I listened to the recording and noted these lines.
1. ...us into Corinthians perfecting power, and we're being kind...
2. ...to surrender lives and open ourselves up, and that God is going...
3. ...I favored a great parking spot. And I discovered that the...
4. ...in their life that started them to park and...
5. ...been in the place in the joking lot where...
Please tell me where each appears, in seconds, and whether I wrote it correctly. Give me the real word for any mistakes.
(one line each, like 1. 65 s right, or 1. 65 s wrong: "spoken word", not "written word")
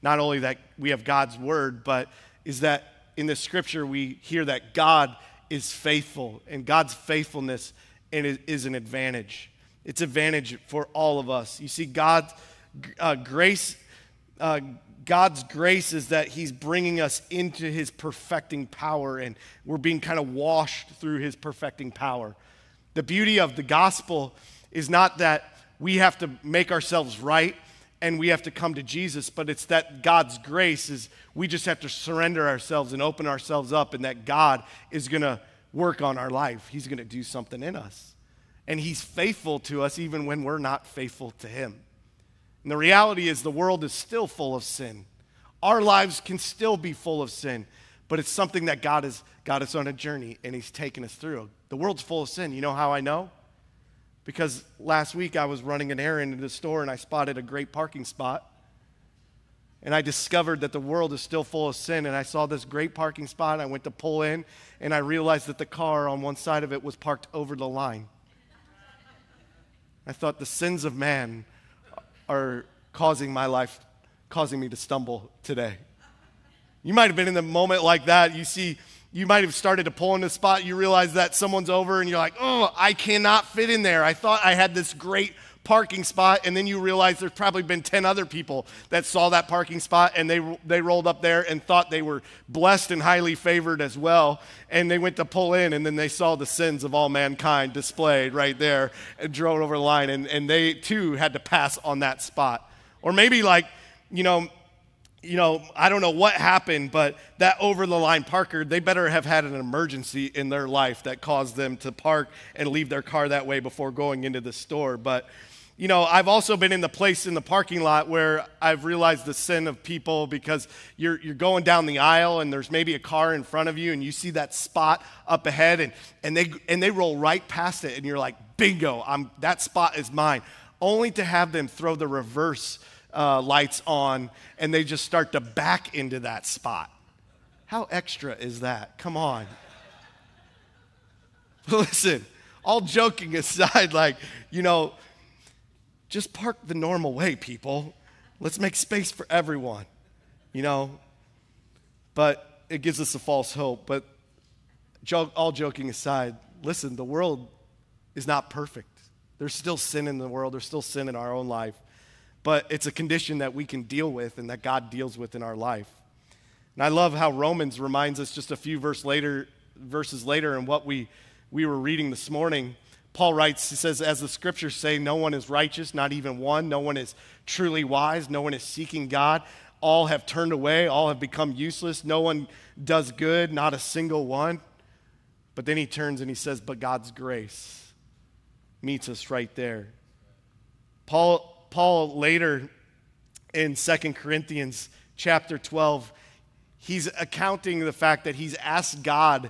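1. 17 s wrong: "His", not "Corinthians"
2. 31 s wrong: "ourselves", not "lives"
3. 56 s wrong: "spotted", not "favored"
4. 110 s wrong: "caused", not "started"
5. 116 s wrong: "parking", not "joking".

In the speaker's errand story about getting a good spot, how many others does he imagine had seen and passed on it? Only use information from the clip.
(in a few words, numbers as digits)
10.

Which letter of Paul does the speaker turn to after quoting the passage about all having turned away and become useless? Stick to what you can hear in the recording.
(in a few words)
2 Corinthians.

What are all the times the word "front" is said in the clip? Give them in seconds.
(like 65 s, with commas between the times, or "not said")
123 s.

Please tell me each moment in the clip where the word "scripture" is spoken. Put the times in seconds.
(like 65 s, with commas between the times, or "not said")
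3 s, 174 s.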